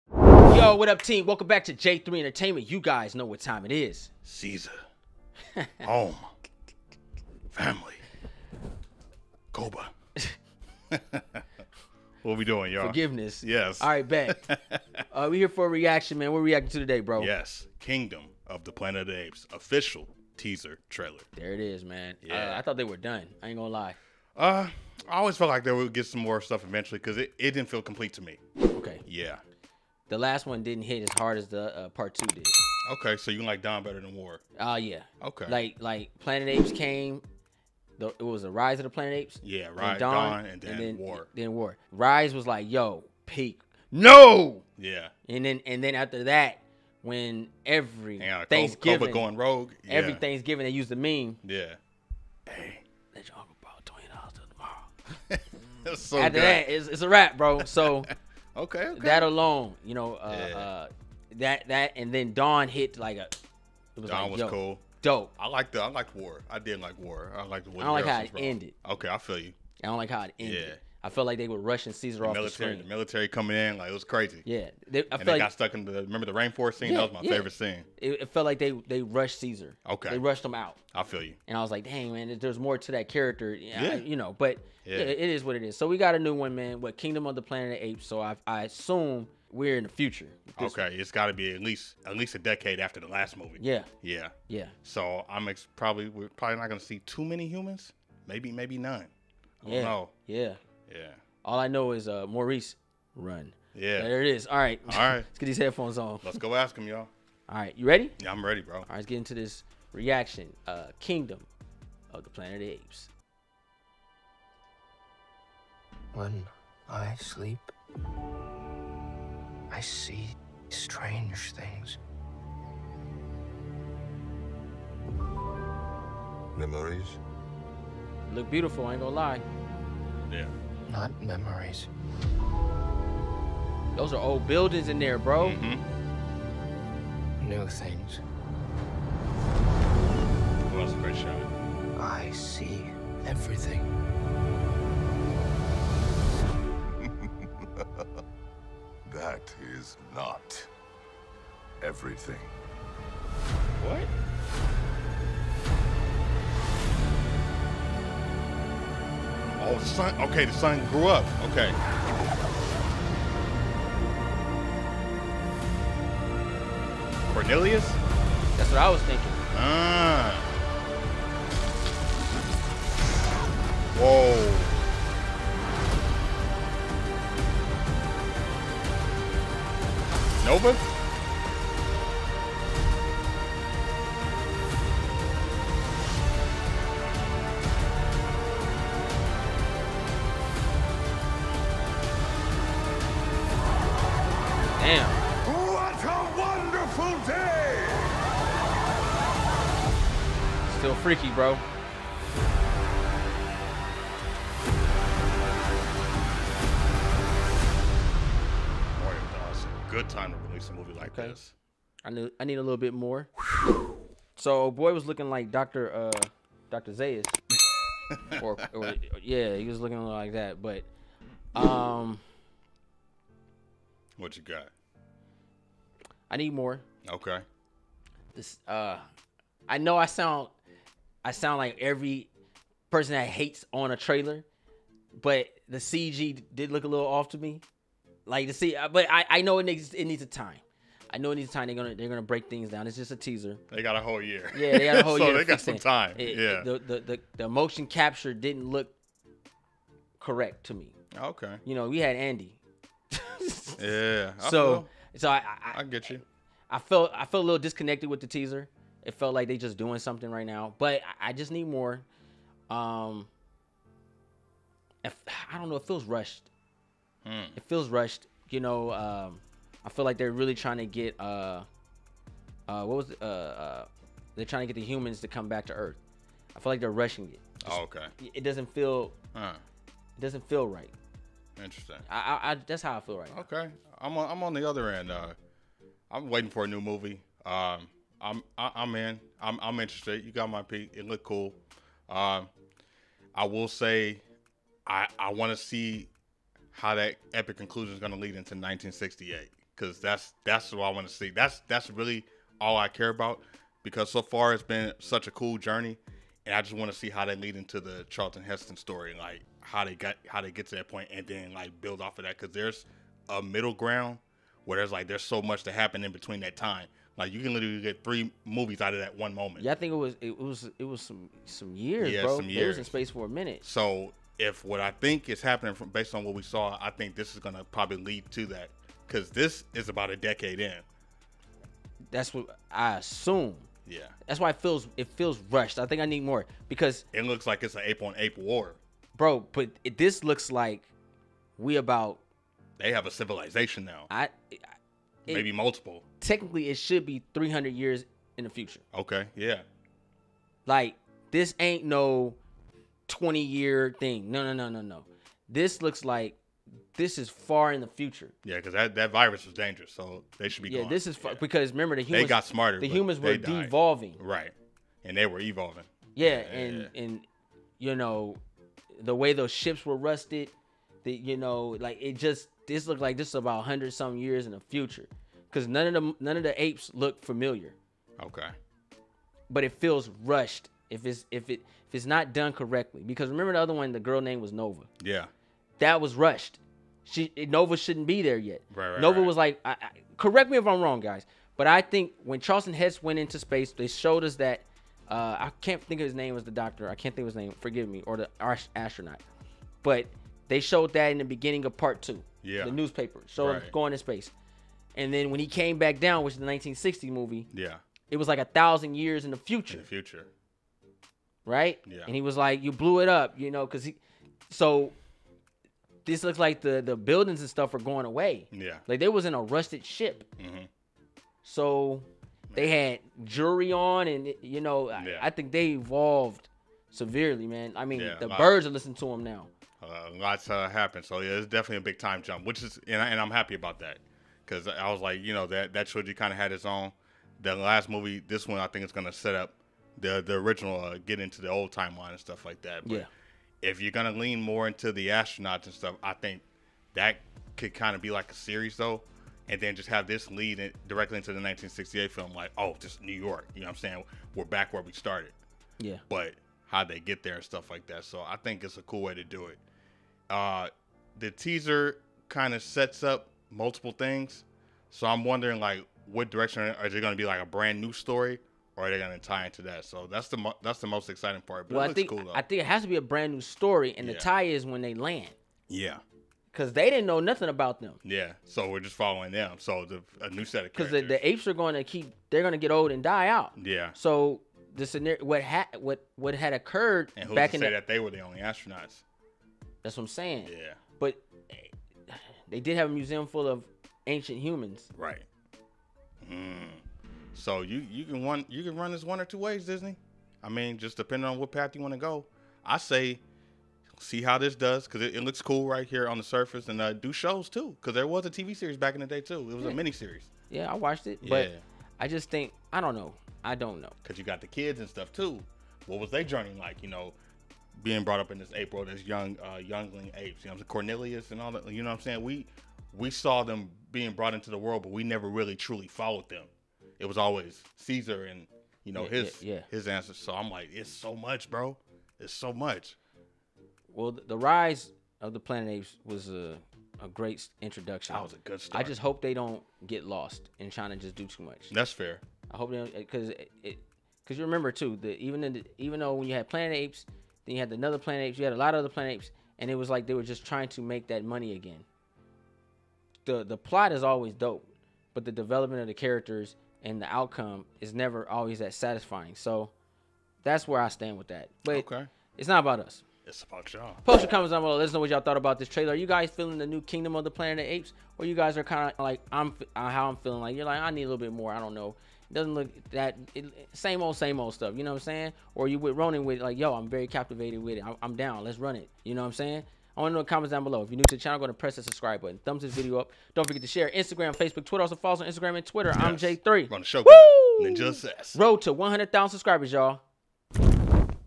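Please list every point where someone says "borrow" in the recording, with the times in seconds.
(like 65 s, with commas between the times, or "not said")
53 s.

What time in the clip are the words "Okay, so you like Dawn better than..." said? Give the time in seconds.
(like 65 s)
33 s.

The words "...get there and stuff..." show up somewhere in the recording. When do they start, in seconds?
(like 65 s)
457 s.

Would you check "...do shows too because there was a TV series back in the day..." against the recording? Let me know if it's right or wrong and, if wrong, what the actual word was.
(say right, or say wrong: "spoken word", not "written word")
right.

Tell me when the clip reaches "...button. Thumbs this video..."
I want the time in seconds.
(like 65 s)
582 s.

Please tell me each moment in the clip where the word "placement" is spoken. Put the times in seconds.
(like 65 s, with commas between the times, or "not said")
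not said.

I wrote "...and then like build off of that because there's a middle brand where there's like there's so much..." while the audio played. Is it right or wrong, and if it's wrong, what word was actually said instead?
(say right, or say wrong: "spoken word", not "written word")
wrong: "ground", not "brand".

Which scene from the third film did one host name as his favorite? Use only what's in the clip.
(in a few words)
The rainforest scene.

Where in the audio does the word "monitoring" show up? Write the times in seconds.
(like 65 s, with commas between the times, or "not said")
not said.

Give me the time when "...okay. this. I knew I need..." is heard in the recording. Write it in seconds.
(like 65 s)
211 s.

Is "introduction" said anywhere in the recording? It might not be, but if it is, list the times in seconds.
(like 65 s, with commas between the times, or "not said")
537 s.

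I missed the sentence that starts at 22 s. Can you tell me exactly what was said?
Uh, I thought they were done.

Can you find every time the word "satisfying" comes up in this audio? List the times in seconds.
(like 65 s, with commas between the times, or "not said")
558 s.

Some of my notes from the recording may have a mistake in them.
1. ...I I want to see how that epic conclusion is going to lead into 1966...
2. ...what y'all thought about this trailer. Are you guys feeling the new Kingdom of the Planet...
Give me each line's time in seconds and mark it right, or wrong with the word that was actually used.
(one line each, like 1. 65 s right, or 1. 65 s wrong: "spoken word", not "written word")
1. 294 s wrong: "1968", not "1966"
2. 564 s right.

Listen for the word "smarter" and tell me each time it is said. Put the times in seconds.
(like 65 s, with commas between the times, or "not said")
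362 s.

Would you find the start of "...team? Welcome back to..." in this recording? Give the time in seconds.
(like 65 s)
1 s.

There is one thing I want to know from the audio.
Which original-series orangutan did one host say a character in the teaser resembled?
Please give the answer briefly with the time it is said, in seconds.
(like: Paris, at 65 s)
Doctor Zaius, at 216 s.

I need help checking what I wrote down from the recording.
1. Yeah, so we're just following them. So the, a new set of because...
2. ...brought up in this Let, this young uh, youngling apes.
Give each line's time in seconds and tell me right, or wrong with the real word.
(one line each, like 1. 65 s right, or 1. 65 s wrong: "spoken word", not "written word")
1. 478 s right
2. 518 s wrong: "April", not "Let".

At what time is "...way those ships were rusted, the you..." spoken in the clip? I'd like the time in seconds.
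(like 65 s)
369 s.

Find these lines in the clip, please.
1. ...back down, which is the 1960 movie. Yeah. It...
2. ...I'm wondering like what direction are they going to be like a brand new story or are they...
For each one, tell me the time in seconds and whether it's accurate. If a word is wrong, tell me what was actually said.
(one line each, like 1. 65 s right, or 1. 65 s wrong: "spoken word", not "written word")
1. 405 s right
2. 465 s right.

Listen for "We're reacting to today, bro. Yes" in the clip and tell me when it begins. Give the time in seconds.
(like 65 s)
16 s.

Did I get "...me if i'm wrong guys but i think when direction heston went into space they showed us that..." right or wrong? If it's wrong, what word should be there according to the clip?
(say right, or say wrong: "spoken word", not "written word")
wrong: "charlton", not "direction".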